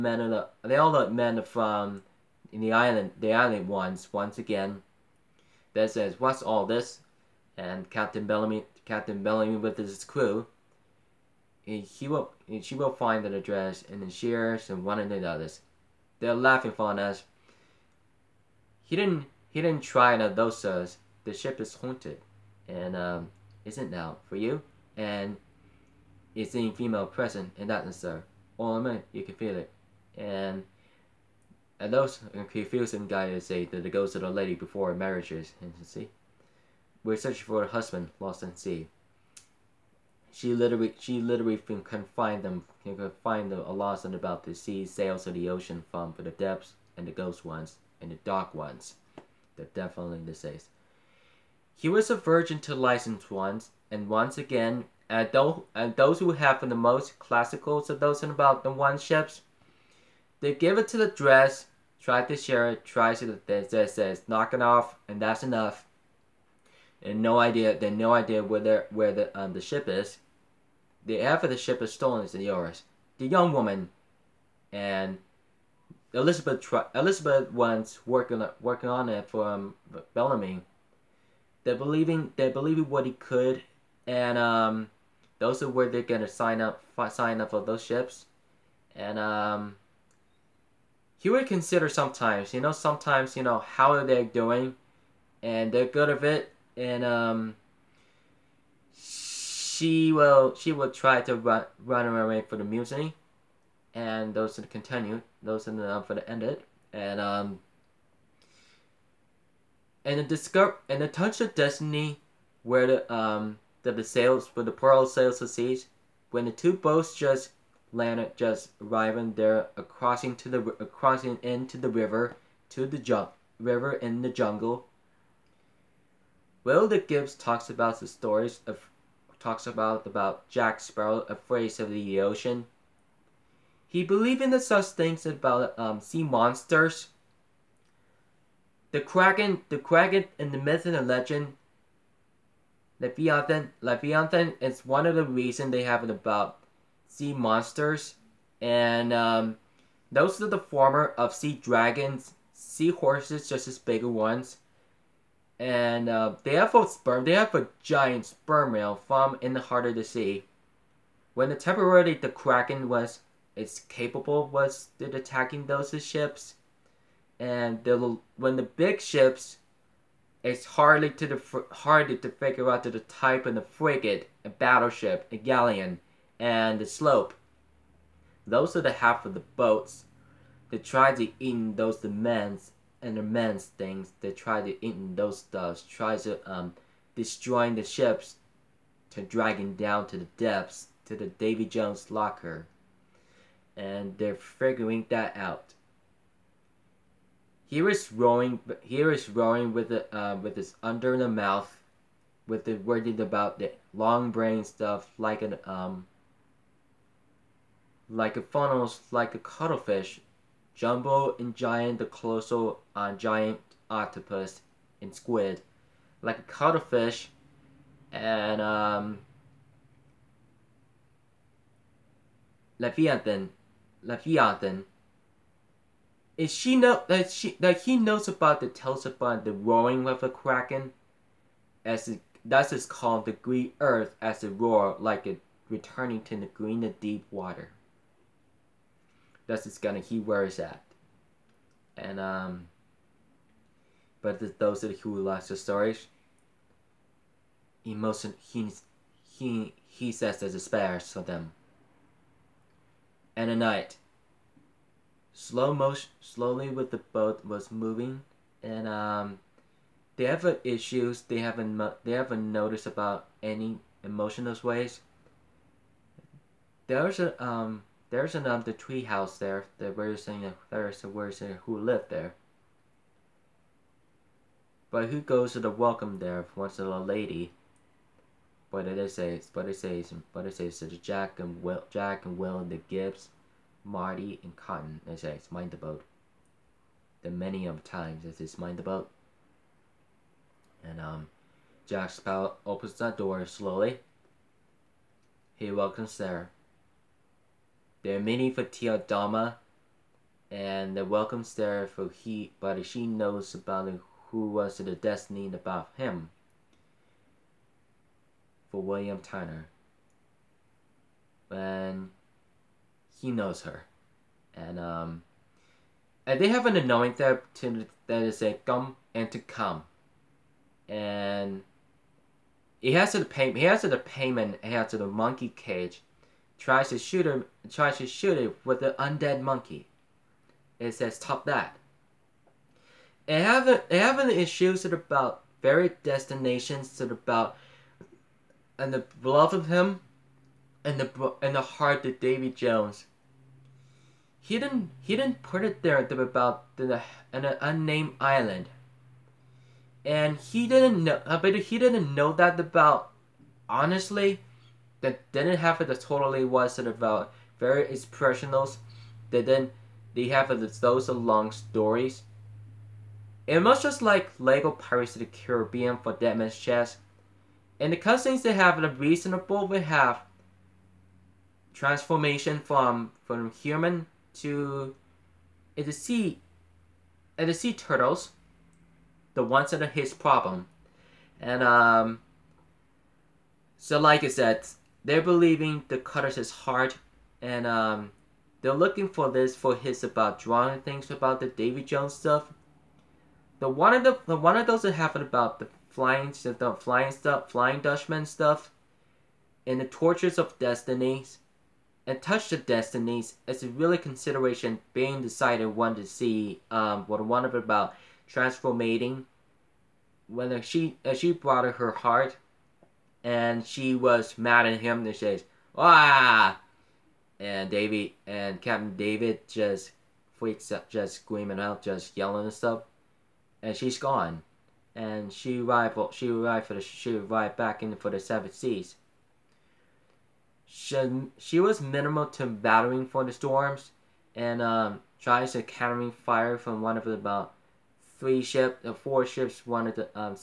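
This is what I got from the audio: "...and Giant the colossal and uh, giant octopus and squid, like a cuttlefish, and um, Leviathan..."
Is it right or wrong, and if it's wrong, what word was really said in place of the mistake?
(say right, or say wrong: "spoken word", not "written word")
right.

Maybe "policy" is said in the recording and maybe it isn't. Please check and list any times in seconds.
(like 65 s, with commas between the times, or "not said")
not said.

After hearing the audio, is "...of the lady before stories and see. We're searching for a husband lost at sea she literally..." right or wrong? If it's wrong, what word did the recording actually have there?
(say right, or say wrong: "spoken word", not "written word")
wrong: "marriages", not "stories".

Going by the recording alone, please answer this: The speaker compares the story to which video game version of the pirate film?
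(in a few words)
Lego Pirates of the Caribbean.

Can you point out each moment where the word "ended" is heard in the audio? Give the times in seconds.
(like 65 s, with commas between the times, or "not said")
106 s.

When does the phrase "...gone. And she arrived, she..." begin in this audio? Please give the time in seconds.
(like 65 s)
423 s.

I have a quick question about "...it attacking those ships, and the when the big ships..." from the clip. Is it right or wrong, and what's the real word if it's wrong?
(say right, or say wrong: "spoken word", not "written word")
right.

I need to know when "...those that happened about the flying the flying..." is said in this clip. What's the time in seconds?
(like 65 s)
394 s.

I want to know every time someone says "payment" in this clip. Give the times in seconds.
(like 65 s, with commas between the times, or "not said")
323 s.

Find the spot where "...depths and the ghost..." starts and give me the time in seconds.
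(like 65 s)
46 s.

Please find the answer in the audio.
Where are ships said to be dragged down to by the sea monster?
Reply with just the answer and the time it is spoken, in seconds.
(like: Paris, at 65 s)
Davy Jones locker, at 191 s.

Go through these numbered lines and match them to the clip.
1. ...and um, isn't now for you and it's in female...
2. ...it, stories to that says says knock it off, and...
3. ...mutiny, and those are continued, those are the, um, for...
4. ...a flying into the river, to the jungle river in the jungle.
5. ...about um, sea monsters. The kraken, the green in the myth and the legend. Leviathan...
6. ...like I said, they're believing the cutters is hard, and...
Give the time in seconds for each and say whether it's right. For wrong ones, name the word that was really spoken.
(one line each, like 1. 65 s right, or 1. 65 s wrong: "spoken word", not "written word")
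1. 22 s right
2. 62 s wrong: "tries", not "stories"
3. 102 s right
4. 120 s wrong: "crossing", not "flying"
5. 135 s wrong: "kraken", not "green"
6. 383 s right.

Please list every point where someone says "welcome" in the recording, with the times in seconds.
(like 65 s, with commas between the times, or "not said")
275 s, 295 s, 301 s.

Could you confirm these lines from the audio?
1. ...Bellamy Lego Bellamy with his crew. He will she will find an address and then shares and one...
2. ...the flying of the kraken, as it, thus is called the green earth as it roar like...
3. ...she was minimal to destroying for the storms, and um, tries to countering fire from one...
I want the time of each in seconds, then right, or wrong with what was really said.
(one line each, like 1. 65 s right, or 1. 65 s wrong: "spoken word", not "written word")
1. 8 s wrong: "Captain", not "Lego"
2. 229 s wrong: "roaring", not "flying"
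3. 431 s wrong: "battling", not "destroying".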